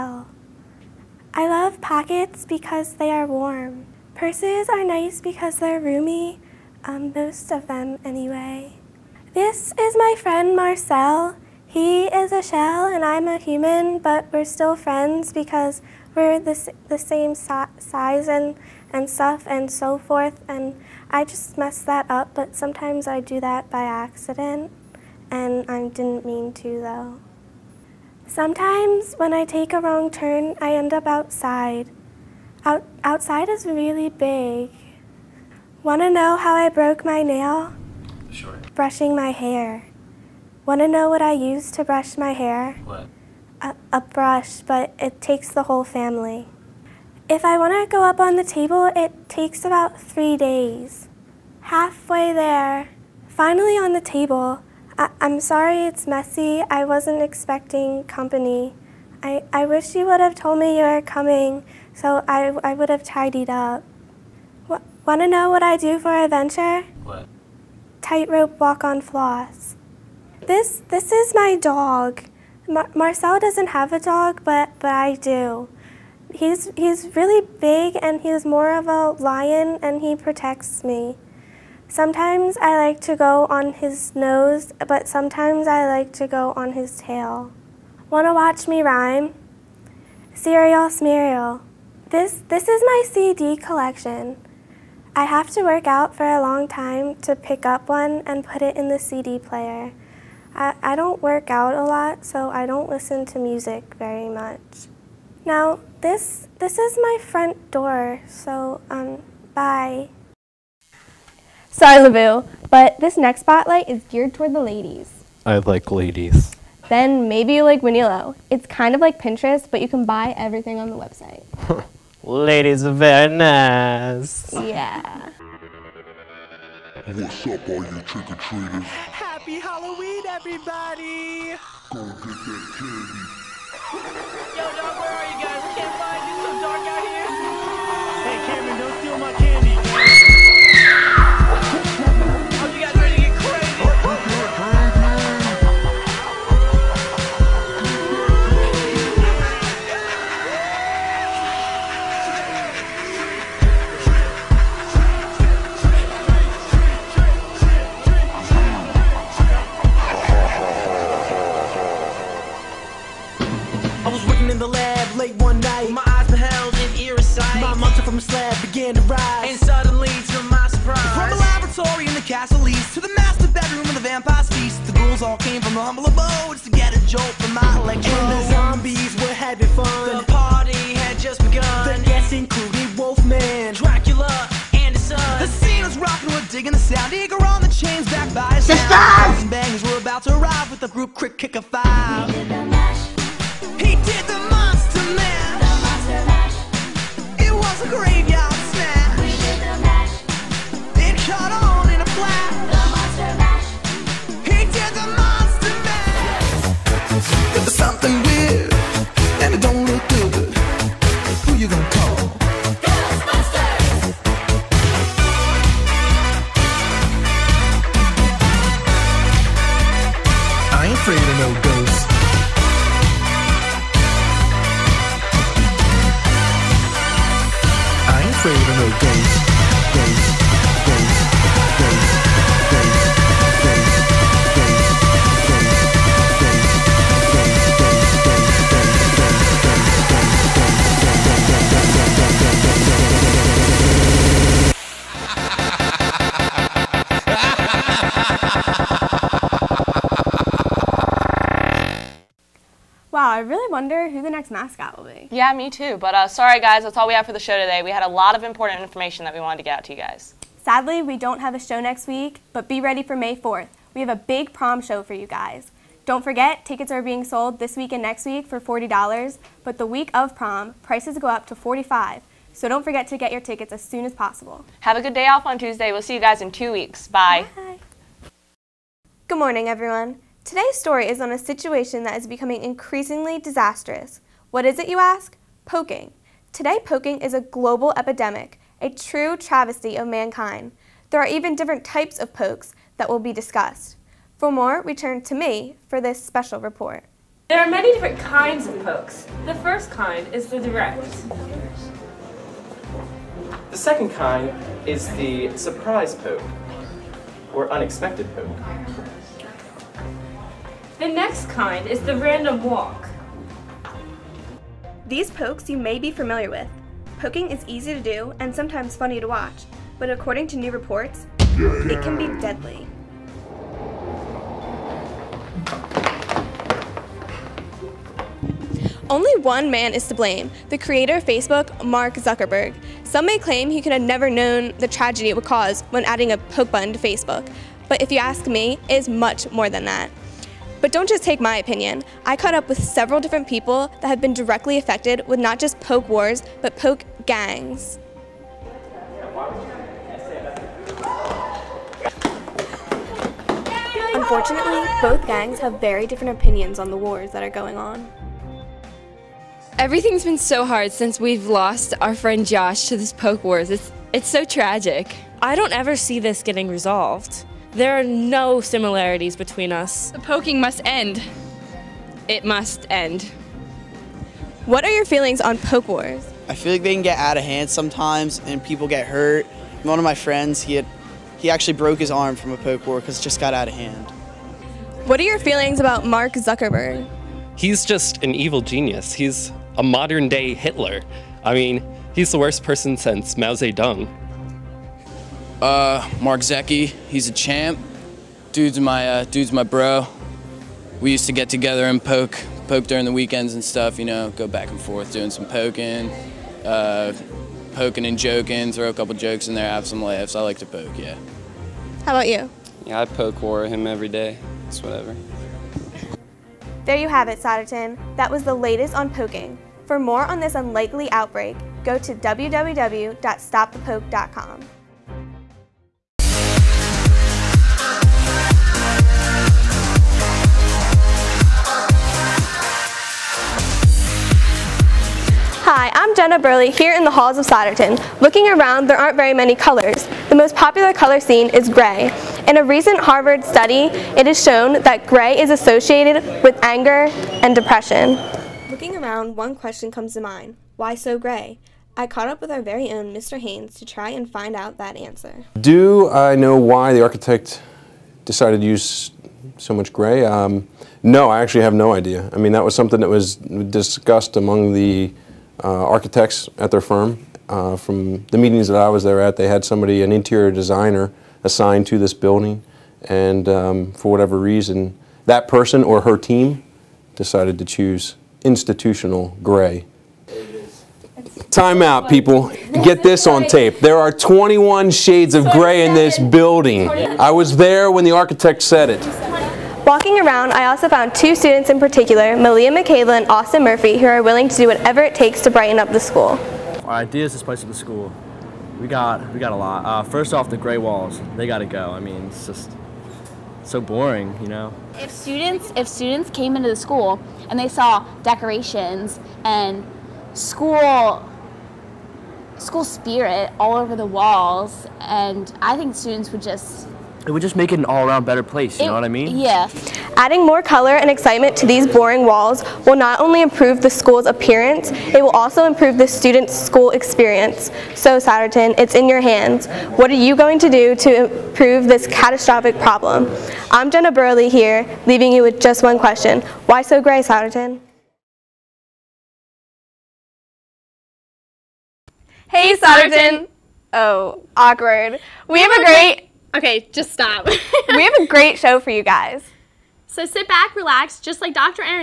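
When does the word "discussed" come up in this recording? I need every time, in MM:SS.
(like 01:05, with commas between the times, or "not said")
04:53, 07:43.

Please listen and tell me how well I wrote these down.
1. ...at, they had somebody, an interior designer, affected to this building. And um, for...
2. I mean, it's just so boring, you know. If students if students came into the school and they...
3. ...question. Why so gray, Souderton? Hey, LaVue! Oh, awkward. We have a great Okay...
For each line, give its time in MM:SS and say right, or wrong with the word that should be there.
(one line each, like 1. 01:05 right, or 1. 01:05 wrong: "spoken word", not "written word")
1. 07:49 wrong: "assigned", not "affected"
2. 08:21 right
3. 08:55 wrong: "Souderton", not "LaVue".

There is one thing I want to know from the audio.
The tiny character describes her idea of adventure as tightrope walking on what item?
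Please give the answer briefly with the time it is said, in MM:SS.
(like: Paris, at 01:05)
Floss, at 01:09.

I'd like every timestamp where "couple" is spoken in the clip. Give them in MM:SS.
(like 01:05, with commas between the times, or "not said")
06:48.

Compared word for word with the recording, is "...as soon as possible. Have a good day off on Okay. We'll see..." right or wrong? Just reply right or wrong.
wrong.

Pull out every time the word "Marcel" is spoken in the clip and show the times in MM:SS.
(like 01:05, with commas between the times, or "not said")
00:10, 01:12.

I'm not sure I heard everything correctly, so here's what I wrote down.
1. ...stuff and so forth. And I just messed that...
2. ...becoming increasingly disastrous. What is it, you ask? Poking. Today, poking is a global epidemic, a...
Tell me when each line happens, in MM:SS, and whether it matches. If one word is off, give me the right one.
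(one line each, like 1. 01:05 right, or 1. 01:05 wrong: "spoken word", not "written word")
1. 00:19 right
2. 04:42 right.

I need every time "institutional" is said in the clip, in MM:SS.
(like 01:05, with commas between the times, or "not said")
07:58.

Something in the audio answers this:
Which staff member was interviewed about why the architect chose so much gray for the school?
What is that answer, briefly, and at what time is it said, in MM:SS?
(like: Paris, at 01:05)
Mr. Haynes, at 07:33.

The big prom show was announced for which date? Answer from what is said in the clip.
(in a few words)
May 4th.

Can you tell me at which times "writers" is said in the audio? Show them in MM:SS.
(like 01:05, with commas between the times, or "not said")
not said.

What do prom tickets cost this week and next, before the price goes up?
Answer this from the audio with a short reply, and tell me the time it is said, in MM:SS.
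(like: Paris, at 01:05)
$40, at 04:28.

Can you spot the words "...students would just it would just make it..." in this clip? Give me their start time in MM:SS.
08:35.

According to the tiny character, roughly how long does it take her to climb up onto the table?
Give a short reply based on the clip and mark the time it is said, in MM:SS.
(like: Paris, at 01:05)
3 days, at 00:50.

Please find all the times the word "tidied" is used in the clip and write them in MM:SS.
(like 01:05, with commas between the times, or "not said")
01:03.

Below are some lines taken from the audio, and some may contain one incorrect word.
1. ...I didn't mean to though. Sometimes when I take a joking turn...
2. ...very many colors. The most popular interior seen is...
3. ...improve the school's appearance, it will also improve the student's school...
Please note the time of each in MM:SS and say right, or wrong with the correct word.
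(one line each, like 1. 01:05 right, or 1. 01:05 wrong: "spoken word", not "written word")
1. 00:25 wrong: "wrong", not "joking"
2. 07:19 wrong: "color", not "interior"
3. 08:43 right.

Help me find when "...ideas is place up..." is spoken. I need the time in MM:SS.
08:17.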